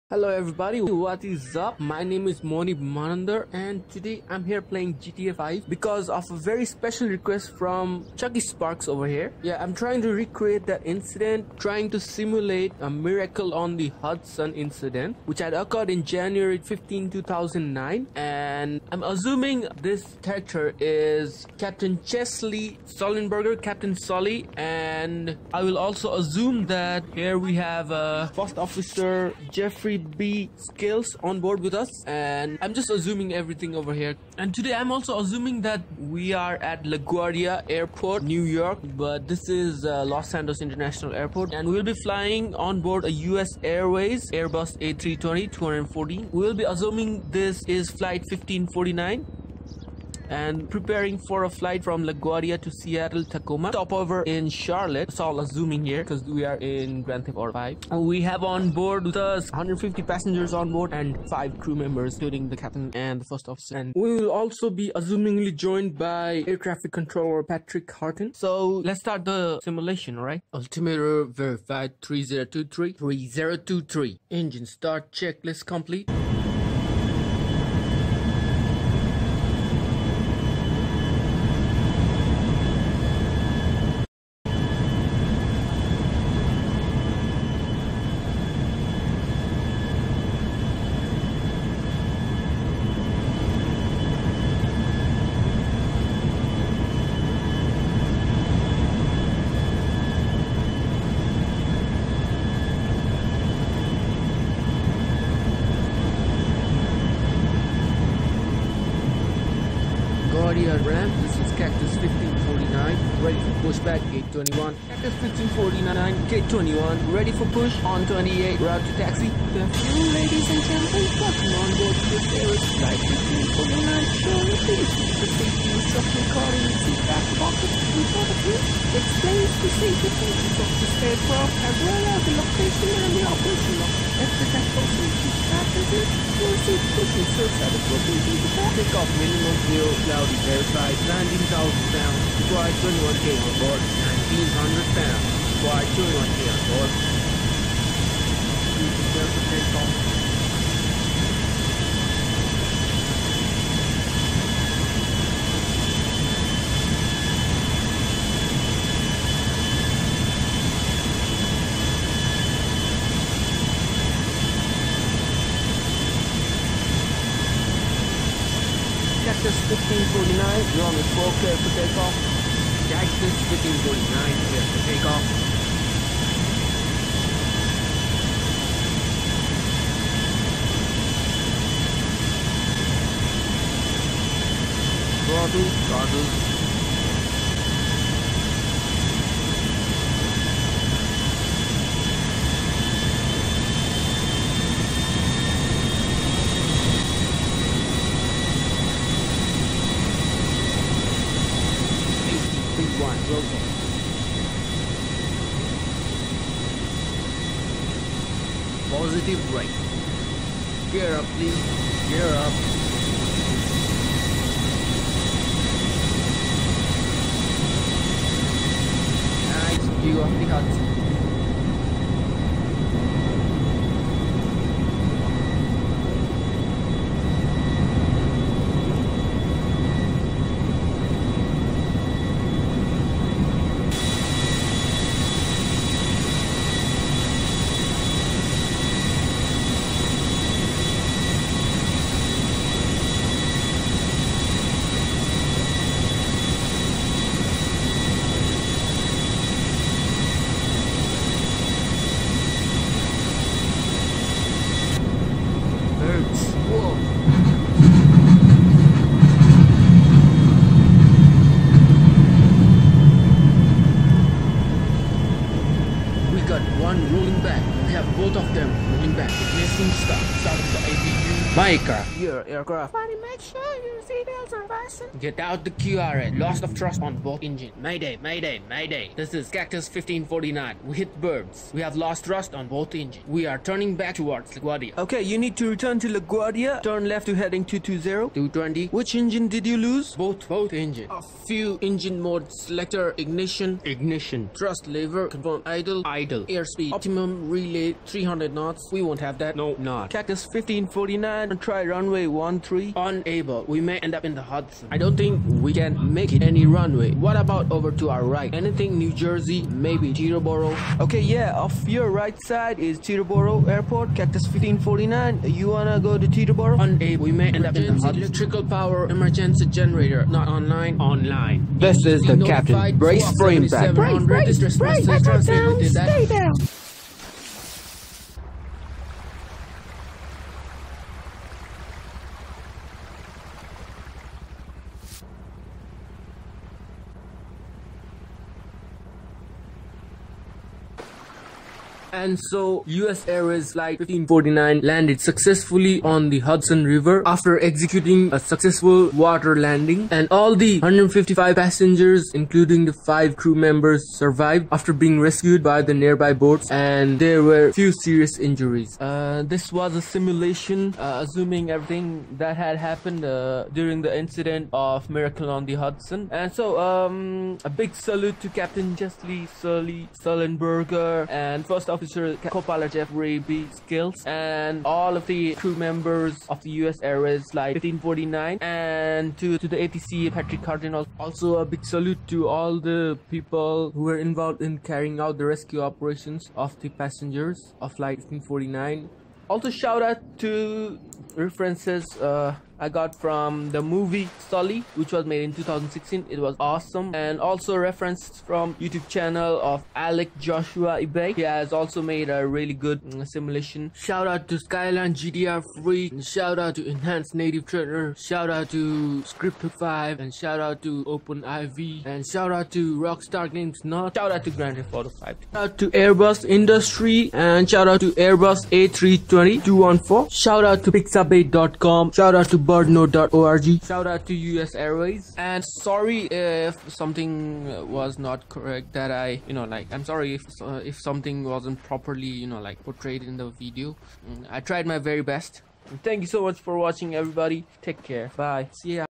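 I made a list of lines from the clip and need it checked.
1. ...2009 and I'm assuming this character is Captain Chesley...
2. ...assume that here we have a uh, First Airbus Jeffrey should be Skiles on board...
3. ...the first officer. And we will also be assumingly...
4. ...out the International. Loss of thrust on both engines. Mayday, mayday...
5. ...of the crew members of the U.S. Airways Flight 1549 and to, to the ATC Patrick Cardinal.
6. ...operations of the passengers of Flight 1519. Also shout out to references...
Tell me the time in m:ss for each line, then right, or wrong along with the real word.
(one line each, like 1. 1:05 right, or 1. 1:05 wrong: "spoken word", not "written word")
1. 0:17 right
2. 0:26 wrong: "Officer", not "Airbus"
3. 1:03 right
4. 4:35 wrong: "QRH", not "International"
5. 6:15 right
6. 6:25 wrong: "1549", not "1519".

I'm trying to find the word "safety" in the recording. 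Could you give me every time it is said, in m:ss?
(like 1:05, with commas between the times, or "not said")
2:05, 2:09.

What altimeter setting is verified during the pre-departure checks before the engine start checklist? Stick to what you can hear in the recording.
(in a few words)
3023.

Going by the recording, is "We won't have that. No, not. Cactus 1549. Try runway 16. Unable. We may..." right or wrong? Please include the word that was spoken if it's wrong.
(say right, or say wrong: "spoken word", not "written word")
wrong: "13", not "16".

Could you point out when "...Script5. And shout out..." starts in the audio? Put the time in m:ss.
6:49.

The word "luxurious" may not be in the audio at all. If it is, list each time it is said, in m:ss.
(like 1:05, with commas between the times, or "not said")
not said.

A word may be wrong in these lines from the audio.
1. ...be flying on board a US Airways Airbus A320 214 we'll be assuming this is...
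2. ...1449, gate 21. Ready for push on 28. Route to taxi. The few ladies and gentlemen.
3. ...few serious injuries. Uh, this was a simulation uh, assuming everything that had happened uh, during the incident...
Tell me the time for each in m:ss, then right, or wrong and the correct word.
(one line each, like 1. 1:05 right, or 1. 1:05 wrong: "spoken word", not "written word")
1. 0:41 right
2. 1:55 wrong: "1549", not "1449"
3. 5:57 right.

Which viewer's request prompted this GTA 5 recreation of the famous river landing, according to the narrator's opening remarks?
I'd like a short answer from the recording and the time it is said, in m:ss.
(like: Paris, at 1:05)
Chucky Sparks, at 0:08.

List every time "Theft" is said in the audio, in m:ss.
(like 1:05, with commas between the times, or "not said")
0:57, 6:54.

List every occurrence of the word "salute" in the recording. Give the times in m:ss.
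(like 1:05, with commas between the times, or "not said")
6:07, 6:21.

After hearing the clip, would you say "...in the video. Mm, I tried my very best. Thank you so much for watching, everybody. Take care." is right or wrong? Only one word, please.
right.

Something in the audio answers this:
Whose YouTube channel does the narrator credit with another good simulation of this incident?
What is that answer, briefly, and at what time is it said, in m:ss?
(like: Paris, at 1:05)
Alec Joshua Ibay, at 6:39.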